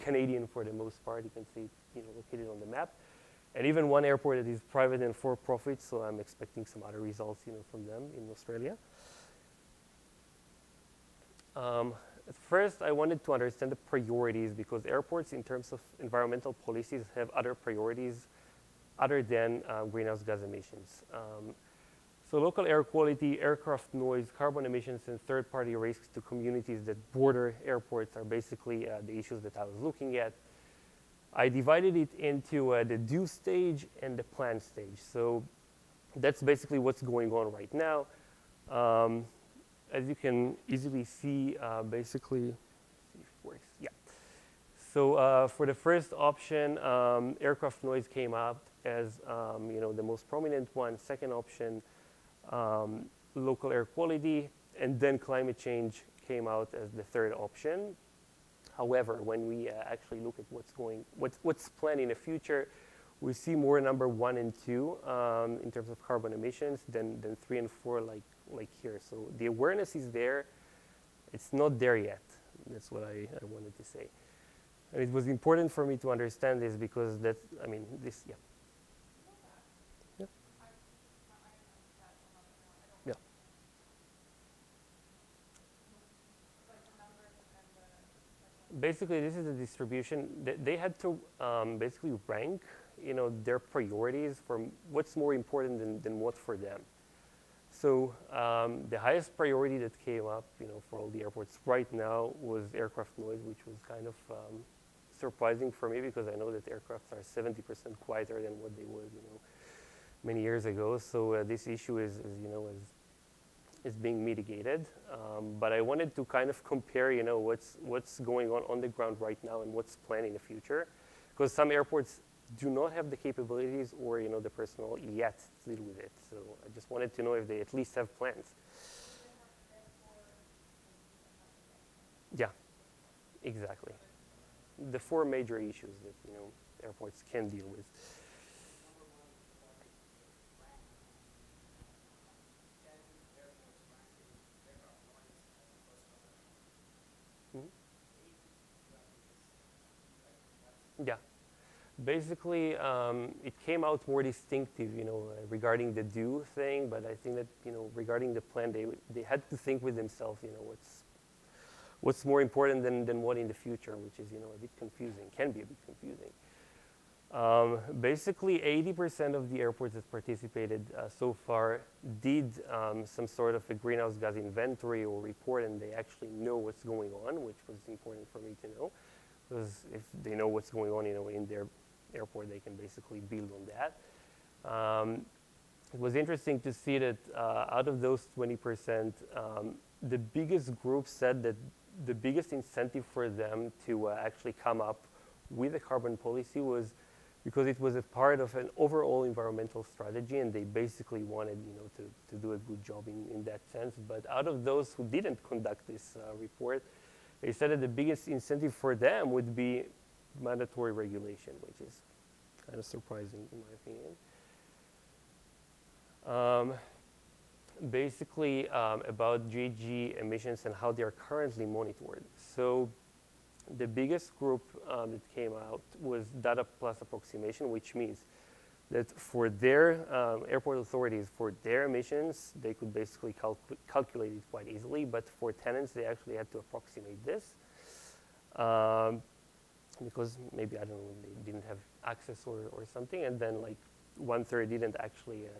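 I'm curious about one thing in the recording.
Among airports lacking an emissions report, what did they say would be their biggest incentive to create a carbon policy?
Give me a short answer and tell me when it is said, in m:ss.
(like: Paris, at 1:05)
Mandatory regulation, at 3:30.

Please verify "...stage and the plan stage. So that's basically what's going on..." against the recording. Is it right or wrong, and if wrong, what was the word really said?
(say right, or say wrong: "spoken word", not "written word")
right.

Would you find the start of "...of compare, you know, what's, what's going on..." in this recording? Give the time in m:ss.
1:56.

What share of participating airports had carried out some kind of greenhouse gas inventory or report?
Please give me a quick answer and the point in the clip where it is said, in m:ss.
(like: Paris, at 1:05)
80%, at 2:48.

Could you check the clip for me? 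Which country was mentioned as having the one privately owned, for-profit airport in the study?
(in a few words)
Australia.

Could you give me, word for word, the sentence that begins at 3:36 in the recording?
Um, basically um, about GHG emissions and how they are currently monitored.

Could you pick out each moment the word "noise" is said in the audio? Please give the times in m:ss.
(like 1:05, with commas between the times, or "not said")
0:23, 0:47, 1:43.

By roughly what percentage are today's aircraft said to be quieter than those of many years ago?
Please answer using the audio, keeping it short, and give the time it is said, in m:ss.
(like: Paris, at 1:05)
70%, at 1:47.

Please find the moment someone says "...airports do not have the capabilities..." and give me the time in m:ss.
2:01.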